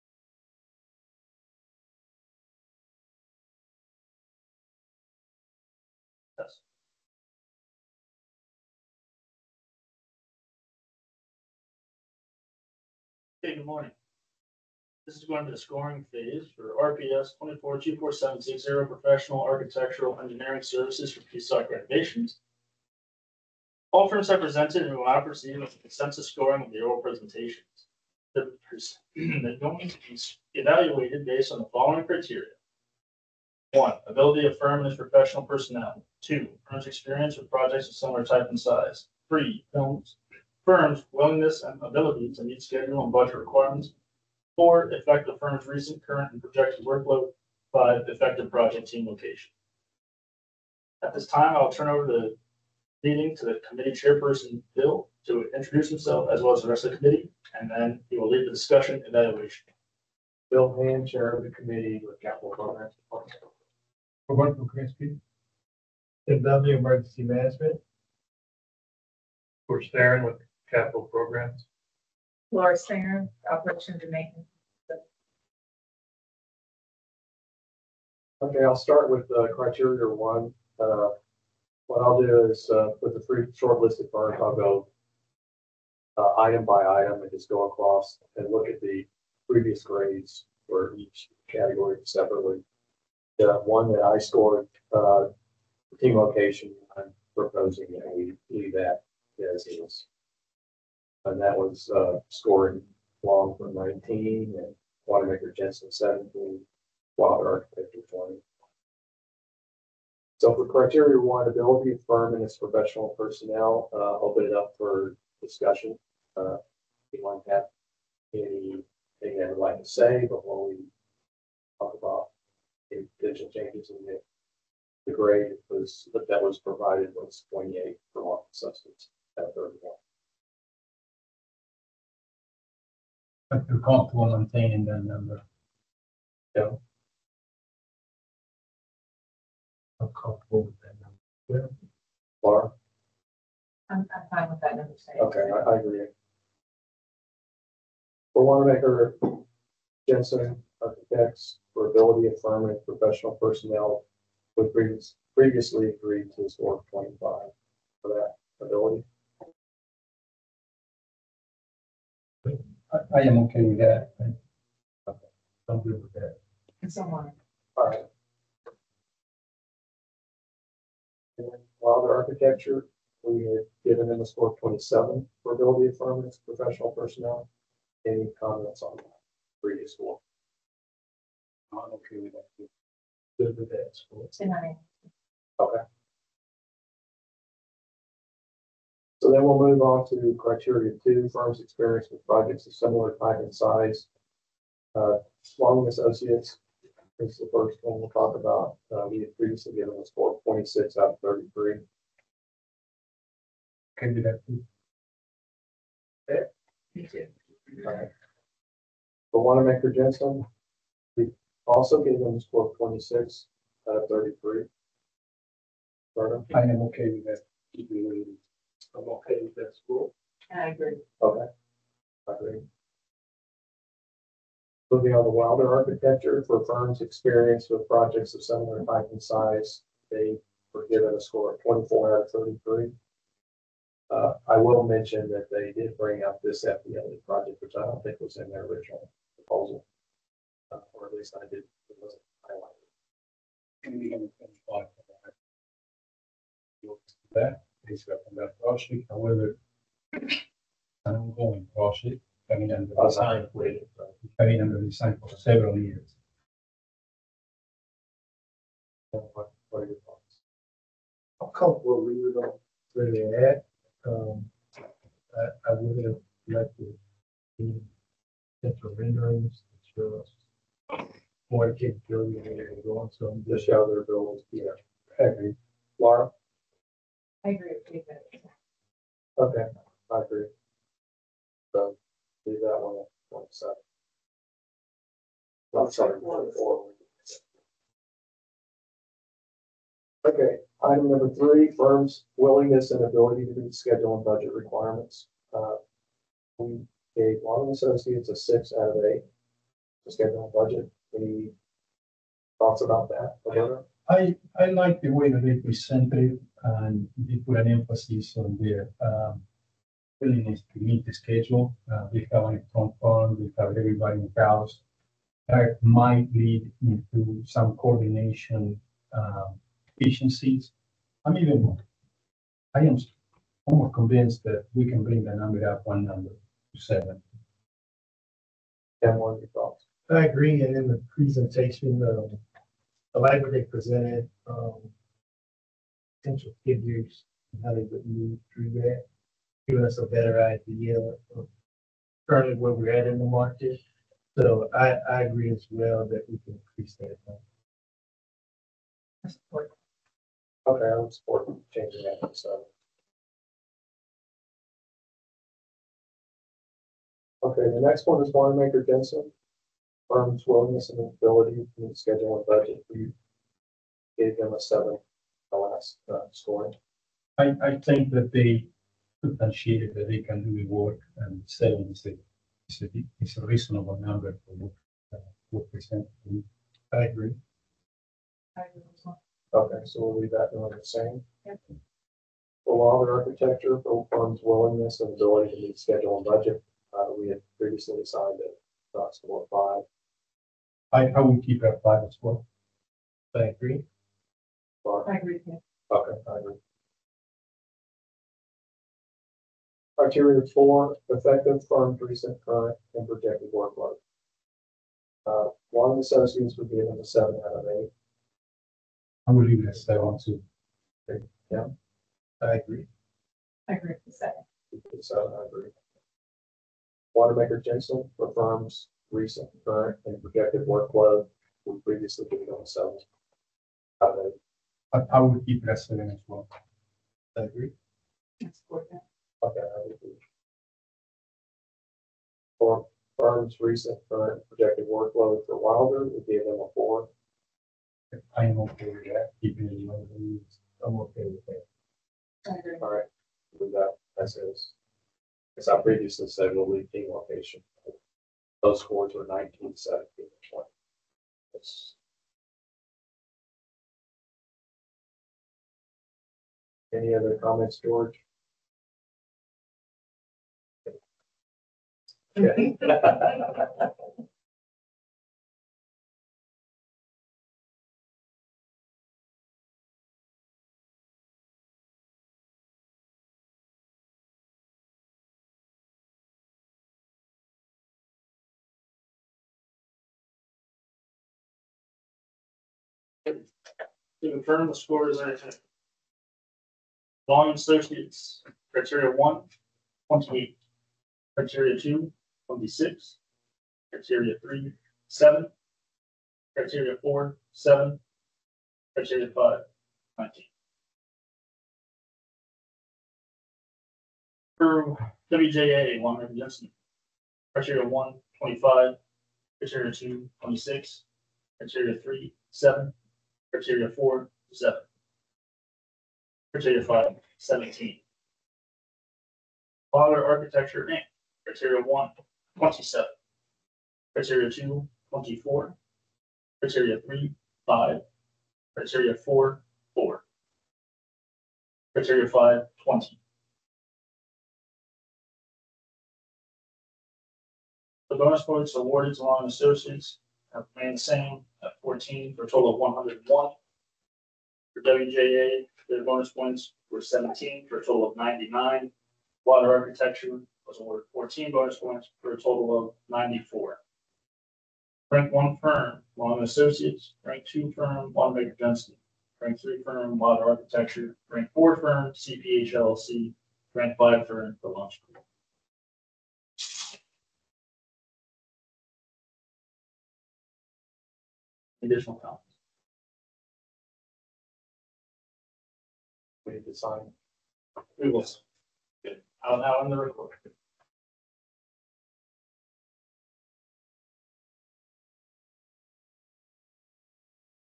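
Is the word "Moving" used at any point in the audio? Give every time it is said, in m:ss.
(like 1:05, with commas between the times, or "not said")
3:44.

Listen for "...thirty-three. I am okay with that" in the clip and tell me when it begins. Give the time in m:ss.
3:34.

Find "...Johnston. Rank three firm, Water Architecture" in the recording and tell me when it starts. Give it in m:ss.
9:18.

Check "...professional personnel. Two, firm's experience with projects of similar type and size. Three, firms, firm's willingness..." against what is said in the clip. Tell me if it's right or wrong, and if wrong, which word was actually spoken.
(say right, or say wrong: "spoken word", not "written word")
right.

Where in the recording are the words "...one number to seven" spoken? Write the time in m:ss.
5:25.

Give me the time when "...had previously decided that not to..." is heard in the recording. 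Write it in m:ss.
6:27.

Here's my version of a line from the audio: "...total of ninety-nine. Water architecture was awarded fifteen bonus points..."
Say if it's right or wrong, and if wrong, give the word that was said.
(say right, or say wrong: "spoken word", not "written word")
wrong: "fourteen", not "fifteen".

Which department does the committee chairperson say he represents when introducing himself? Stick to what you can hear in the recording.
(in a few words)
Capital Programs Department.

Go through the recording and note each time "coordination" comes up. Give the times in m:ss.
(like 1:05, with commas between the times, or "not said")
5:17.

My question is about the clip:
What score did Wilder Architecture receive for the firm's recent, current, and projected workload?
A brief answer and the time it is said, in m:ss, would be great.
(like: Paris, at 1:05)
4, at 7:16.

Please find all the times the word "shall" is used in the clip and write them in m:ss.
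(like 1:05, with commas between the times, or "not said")
not said.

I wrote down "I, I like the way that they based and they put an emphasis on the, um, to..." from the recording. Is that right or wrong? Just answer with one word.
wrong.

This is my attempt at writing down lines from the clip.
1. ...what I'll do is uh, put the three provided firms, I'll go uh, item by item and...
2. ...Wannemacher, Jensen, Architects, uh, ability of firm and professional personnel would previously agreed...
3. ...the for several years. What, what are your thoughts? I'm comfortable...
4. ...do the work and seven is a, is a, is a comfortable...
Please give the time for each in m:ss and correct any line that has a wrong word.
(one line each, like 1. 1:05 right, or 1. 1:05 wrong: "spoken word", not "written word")
1. 1:21 wrong: "shortlisted", not "provided"
2. 2:28 right
3. 4:14 right
4. 6:10 wrong: "reasonable", not "comfortable".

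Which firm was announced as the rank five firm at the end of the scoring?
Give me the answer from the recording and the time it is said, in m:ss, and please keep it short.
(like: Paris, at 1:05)
The Launch Group, at 9:24.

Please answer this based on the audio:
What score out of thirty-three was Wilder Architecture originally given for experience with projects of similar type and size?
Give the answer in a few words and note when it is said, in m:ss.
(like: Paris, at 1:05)
24, at 3:51.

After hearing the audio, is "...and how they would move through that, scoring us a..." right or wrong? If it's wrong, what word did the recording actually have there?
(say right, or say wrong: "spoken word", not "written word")
wrong: "giving", not "scoring".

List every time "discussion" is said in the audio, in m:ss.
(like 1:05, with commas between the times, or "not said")
0:58, 1:55.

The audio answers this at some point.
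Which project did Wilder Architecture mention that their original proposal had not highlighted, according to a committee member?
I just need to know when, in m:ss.
3:56.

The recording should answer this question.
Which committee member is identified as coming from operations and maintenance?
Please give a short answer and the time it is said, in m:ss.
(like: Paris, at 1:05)
Laura Singer, at 1:12.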